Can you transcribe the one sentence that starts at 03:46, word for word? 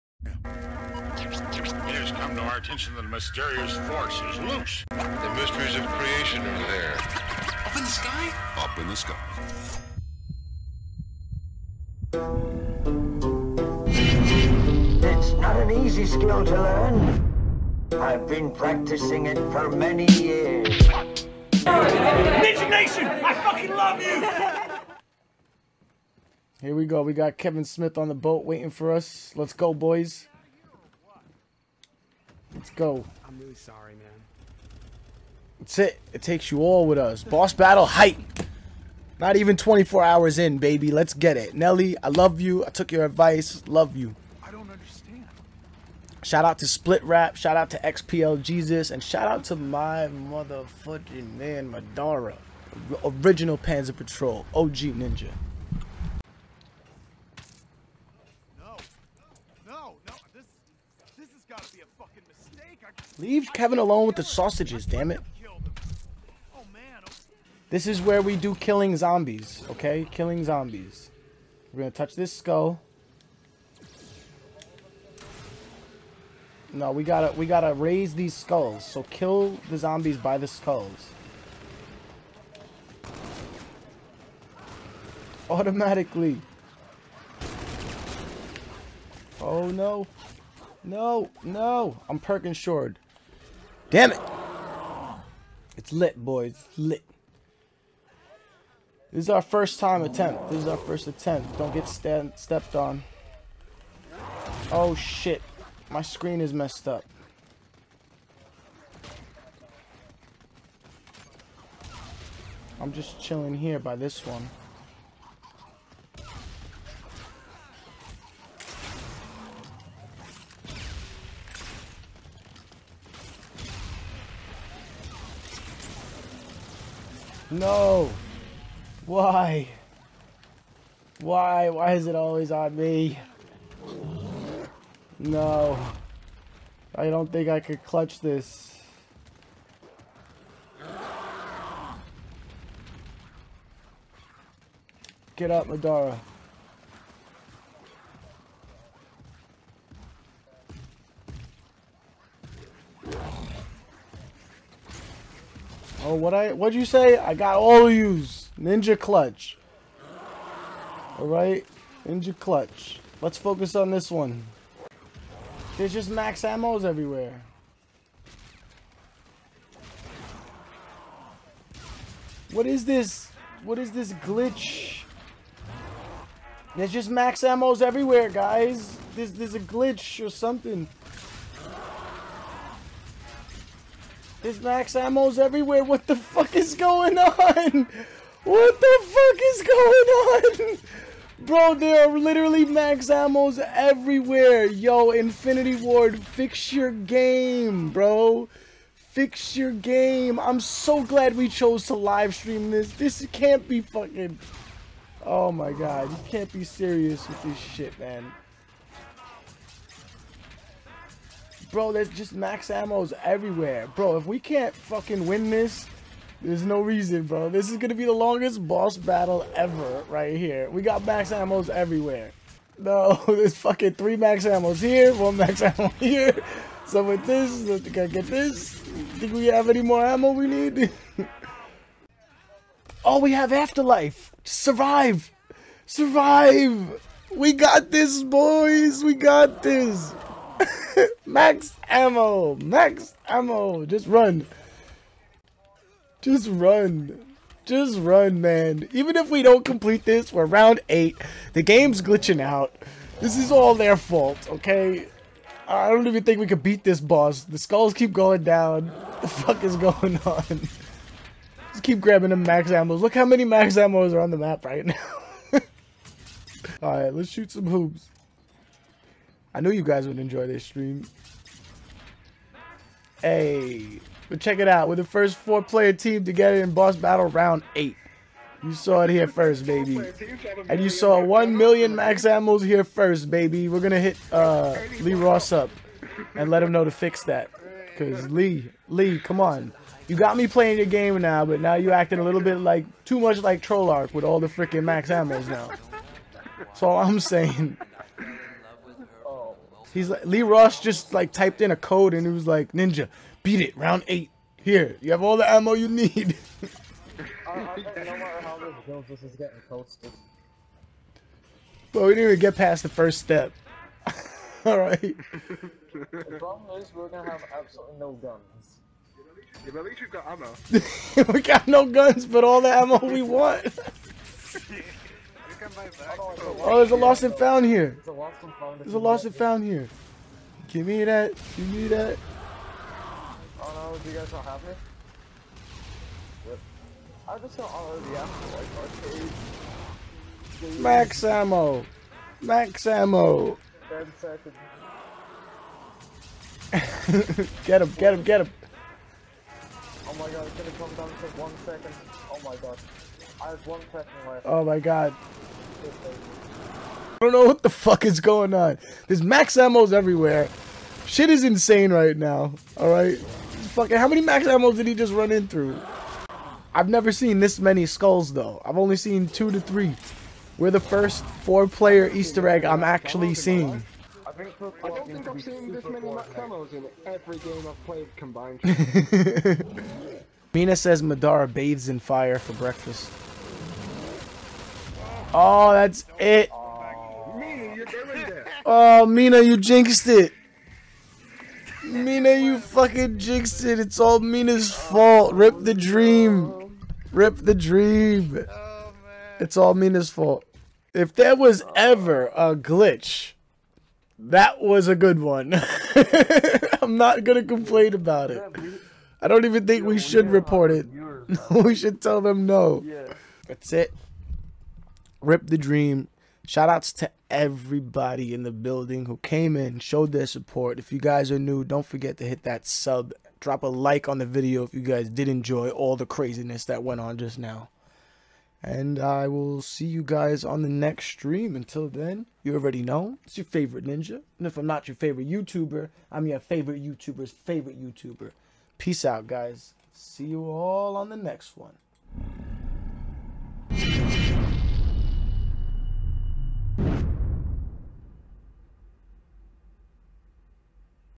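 So with this, I think I get this.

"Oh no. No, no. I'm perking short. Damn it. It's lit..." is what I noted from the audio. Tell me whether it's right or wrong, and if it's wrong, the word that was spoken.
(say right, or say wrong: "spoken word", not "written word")
right.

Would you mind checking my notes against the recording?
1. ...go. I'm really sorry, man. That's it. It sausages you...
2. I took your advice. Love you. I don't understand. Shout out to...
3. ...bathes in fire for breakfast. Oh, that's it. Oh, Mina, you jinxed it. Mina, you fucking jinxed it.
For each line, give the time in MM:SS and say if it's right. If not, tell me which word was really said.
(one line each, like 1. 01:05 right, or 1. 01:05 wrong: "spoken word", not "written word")
1. 00:32 wrong: "takes", not "sausages"
2. 00:42 right
3. 06:21 right.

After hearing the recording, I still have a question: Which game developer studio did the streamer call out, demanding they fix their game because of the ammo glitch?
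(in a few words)
Infinity Ward.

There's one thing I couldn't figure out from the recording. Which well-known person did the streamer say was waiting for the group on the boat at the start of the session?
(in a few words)
Kevin Smith.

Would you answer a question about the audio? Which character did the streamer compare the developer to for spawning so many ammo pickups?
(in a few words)
Trollark.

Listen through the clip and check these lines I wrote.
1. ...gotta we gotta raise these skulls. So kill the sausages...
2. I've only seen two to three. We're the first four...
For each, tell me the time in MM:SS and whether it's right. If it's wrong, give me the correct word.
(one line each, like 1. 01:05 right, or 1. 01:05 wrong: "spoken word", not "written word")
1. 01:17 wrong: "zombies", not "sausages"
2. 06:08 right.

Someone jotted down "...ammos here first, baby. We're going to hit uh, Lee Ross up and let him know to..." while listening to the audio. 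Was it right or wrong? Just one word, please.
right.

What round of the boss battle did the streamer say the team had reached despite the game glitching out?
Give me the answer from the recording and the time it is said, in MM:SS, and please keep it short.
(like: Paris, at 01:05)
Round 8, at 04:10.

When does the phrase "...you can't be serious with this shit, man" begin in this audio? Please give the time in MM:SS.
03:26.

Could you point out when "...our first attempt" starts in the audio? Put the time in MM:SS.
01:40.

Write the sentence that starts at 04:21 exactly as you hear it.
Just keep grabbing the max ammo.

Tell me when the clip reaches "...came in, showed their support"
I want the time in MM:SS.
06:59.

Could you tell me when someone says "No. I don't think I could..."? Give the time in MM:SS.
02:15.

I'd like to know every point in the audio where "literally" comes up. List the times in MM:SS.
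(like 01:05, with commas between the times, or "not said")
03:12.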